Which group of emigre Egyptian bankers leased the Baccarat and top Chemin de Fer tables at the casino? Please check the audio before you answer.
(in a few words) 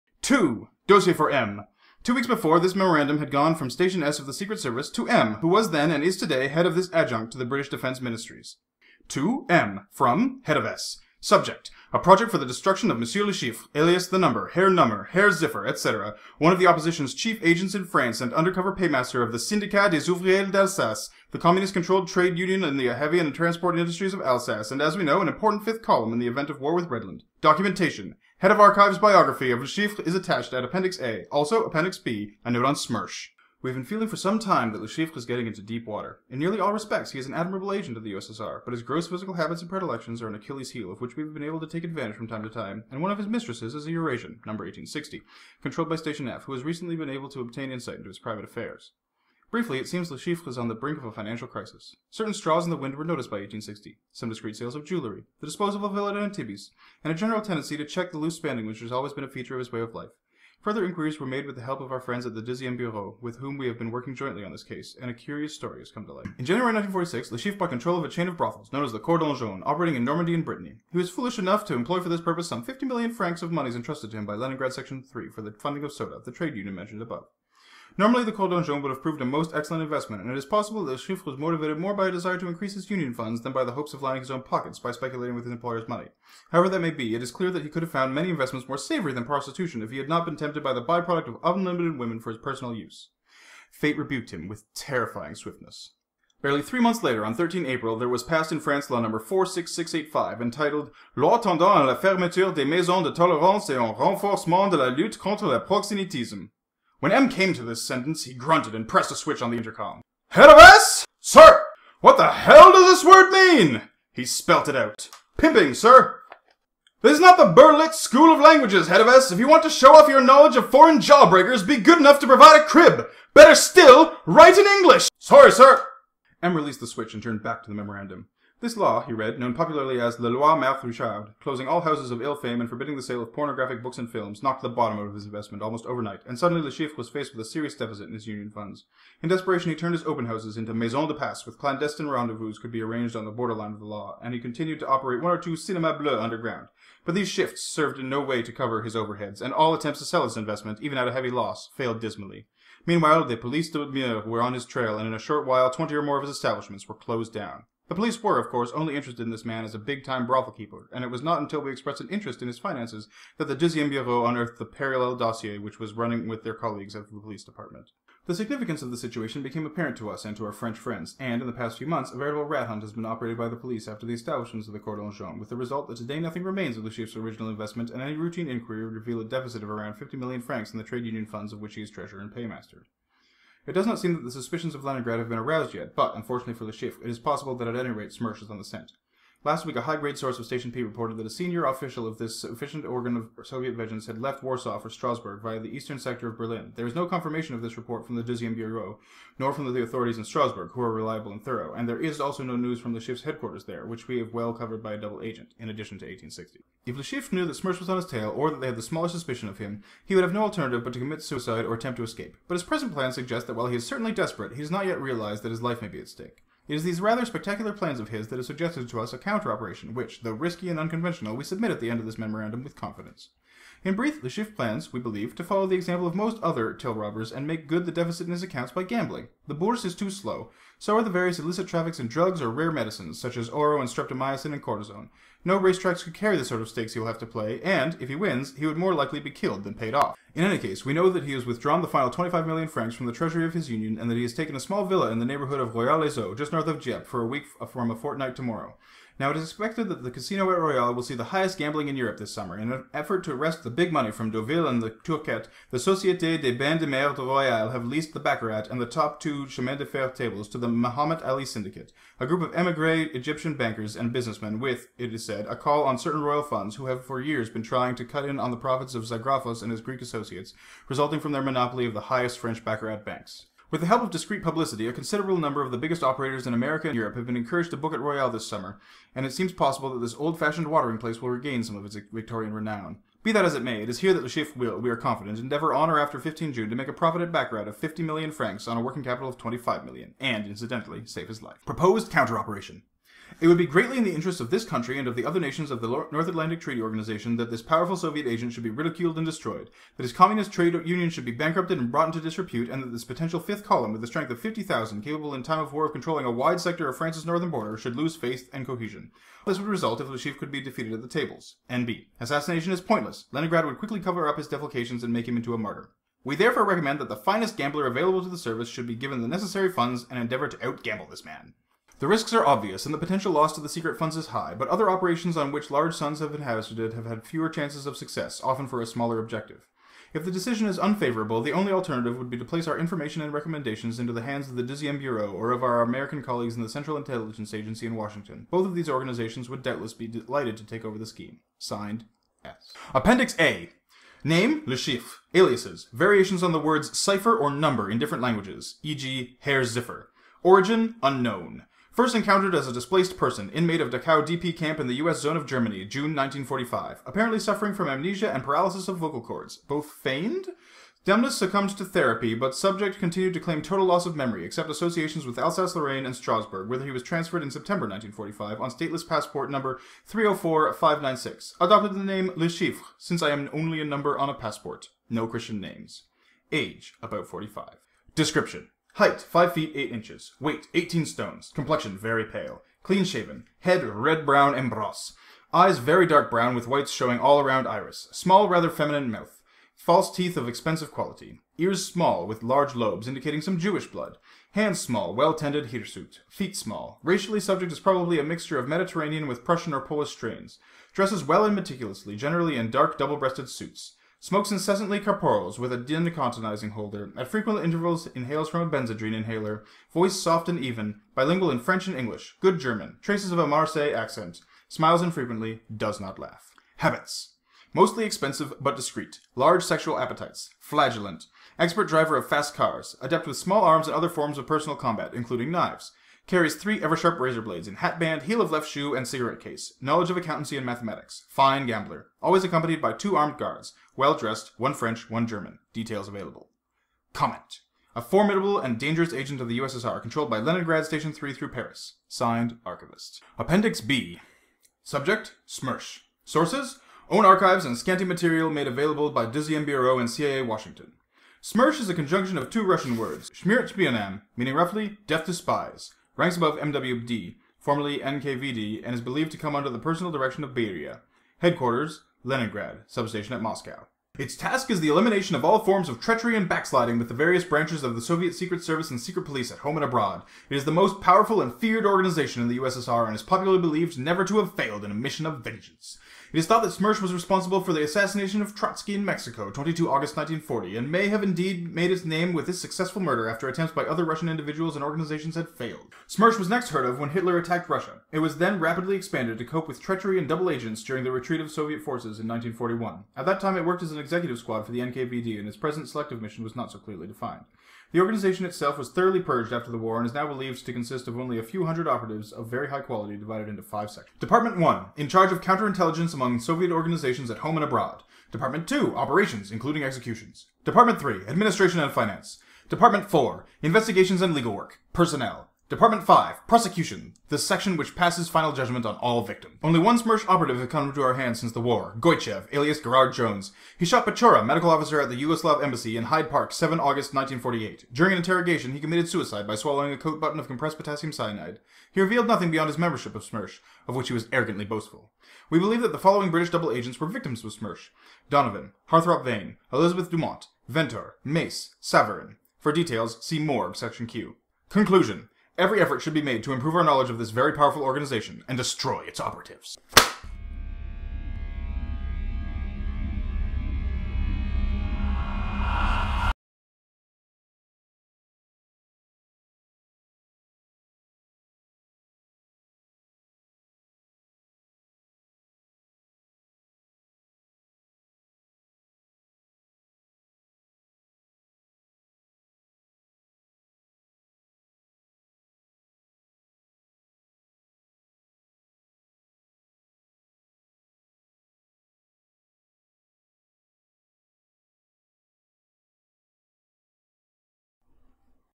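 Muhammad Ali Syndicate.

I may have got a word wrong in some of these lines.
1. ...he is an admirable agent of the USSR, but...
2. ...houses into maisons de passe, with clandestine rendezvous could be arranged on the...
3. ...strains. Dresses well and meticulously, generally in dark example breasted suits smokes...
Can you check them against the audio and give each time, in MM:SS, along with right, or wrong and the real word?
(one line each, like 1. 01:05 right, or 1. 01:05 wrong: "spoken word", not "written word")
1. 00:37 right
2. 02:20 right
3. 06:40 wrong: "double", not "example".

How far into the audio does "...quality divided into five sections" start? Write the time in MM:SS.
08:22.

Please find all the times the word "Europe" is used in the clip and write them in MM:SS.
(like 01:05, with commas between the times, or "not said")
04:11, 04:36.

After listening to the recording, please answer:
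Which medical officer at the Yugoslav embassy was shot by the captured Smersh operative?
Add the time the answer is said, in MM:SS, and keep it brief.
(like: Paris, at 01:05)
Petchora, at 08:44.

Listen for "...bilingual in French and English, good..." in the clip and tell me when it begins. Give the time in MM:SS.
06:51.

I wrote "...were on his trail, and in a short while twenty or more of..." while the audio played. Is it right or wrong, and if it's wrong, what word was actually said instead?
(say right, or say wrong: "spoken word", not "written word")
right.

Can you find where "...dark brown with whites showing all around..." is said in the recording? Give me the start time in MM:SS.
06:26.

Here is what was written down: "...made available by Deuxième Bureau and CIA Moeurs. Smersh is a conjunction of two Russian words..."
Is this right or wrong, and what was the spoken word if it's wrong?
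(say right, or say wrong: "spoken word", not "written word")
wrong: "Washington", not "Moeurs".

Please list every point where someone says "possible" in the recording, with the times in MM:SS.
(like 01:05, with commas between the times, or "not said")
01:20, 03:07, 04:39.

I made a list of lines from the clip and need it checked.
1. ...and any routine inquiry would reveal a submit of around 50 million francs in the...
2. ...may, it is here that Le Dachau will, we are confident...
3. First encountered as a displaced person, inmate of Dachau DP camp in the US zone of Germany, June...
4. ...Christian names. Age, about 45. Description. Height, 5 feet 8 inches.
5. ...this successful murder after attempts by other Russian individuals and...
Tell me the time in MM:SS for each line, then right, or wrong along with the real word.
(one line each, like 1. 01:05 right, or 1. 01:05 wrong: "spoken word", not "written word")
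1. 02:57 wrong: "deficit", not "submit"
2. 04:43 wrong: "Chiffre", not "Dachau"
3. 05:51 right
4. 06:15 right
5. 08:02 right.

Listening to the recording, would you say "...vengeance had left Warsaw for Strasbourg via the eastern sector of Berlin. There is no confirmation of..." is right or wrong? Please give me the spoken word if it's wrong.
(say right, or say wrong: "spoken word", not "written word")
right.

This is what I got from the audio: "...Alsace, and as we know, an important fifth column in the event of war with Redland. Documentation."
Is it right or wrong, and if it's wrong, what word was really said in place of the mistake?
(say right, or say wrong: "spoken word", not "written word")
right.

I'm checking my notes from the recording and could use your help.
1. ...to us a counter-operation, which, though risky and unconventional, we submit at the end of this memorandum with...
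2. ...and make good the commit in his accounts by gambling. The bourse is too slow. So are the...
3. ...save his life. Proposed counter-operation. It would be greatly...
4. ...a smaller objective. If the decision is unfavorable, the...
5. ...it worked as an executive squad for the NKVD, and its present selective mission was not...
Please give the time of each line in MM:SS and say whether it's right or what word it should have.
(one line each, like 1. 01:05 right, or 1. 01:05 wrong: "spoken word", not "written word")
1. 03:38 right
2. 03:47 wrong: "deficit", not "commit"
3. 04:51 right
4. 05:28 right
5. 08:13 right.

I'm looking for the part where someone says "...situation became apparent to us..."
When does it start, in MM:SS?
02:48.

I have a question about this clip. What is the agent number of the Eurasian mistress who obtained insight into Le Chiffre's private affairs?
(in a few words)
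1860.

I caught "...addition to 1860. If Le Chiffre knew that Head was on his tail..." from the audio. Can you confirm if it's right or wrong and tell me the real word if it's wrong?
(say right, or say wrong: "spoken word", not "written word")
wrong: "Smersh", not "Head".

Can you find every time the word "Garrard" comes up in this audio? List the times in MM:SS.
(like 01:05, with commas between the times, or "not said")
08:42.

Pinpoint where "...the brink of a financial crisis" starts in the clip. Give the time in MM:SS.
00:50.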